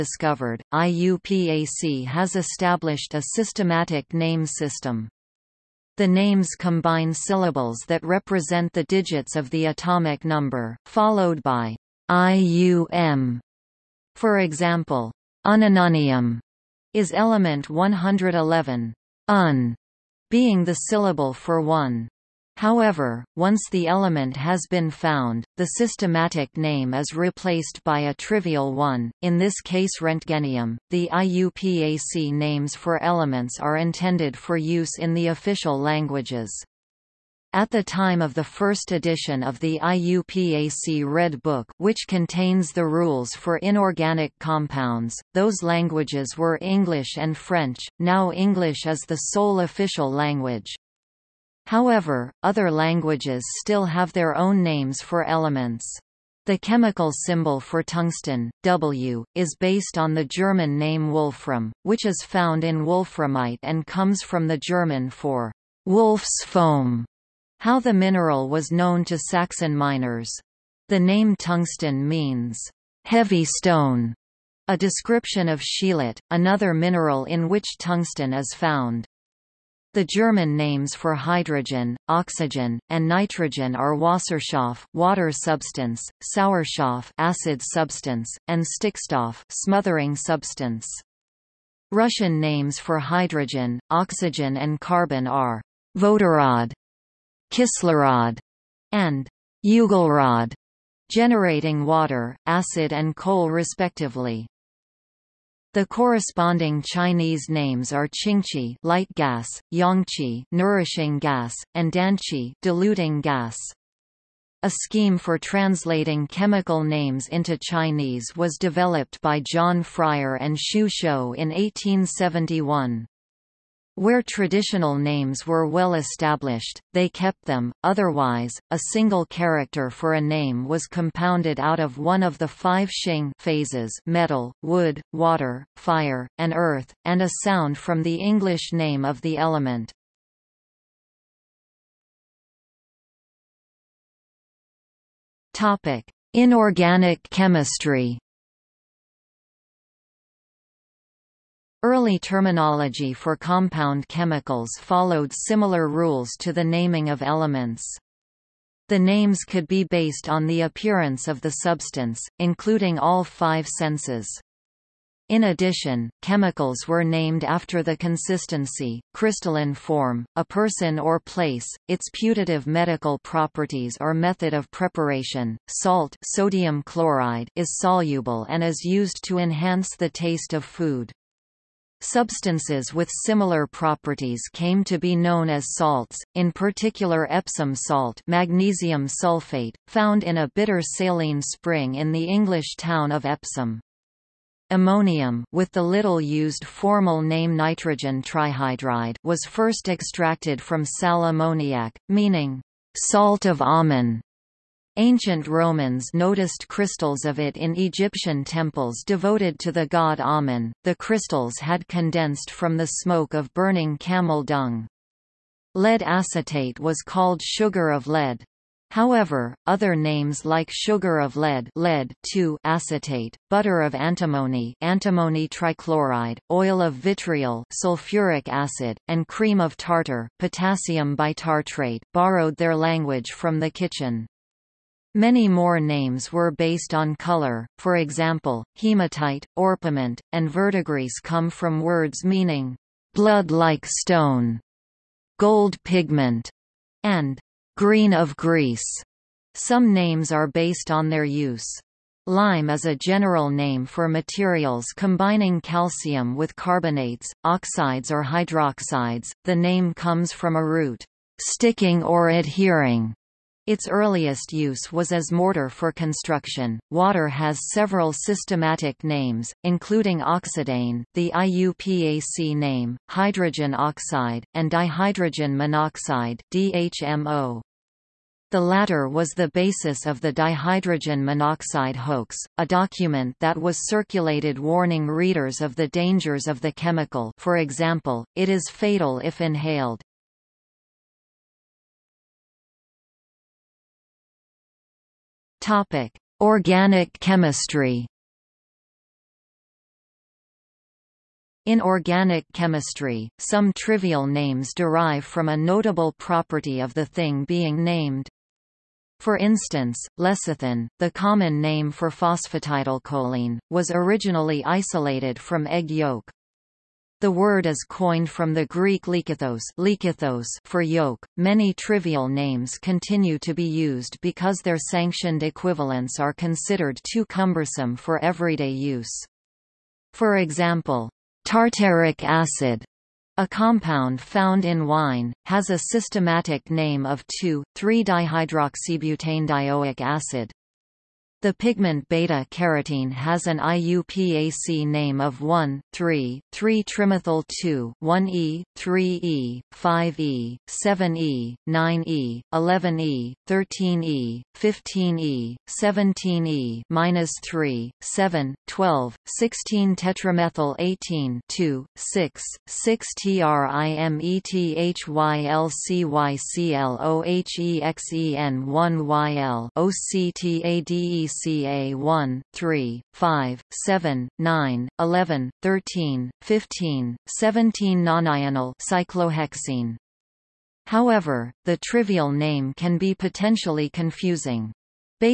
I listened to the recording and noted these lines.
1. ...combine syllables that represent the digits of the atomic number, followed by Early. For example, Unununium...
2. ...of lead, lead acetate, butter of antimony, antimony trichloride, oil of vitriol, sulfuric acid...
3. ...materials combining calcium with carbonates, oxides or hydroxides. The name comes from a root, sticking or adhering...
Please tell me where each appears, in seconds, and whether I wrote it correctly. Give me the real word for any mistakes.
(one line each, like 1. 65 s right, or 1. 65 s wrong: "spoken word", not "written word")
1. 6 s wrong: "IUM", not "Early"
2. 221 s right
3. 254 s right.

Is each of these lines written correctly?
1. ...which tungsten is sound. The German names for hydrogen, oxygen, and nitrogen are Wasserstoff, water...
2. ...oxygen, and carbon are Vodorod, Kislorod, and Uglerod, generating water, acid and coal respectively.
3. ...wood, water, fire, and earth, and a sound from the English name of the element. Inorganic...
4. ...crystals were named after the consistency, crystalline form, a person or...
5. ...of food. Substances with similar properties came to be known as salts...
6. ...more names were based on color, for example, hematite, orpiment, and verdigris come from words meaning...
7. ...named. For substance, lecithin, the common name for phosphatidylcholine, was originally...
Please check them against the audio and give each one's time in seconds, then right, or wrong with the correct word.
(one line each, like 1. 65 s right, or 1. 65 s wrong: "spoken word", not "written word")
1. 77 s wrong: "found", not "sound"
2. 93 s right
3. 134 s right
4. 166 s wrong: "chemicals", not "crystals"
5. 180 s right
6. 235 s right
7. 307 s wrong: "instance", not "substance".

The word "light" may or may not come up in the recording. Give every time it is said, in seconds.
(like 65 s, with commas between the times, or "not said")
108 s.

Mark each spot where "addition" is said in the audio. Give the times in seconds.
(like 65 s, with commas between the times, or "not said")
165 s.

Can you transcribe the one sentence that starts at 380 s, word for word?
However, the trivial name can be potentially confusing.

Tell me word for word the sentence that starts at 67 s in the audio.
How the mineral was known to Saxon miners.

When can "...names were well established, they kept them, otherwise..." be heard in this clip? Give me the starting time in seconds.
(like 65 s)
124 s.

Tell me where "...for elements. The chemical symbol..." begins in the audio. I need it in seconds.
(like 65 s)
55 s.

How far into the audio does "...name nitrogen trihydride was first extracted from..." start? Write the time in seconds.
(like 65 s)
197 s.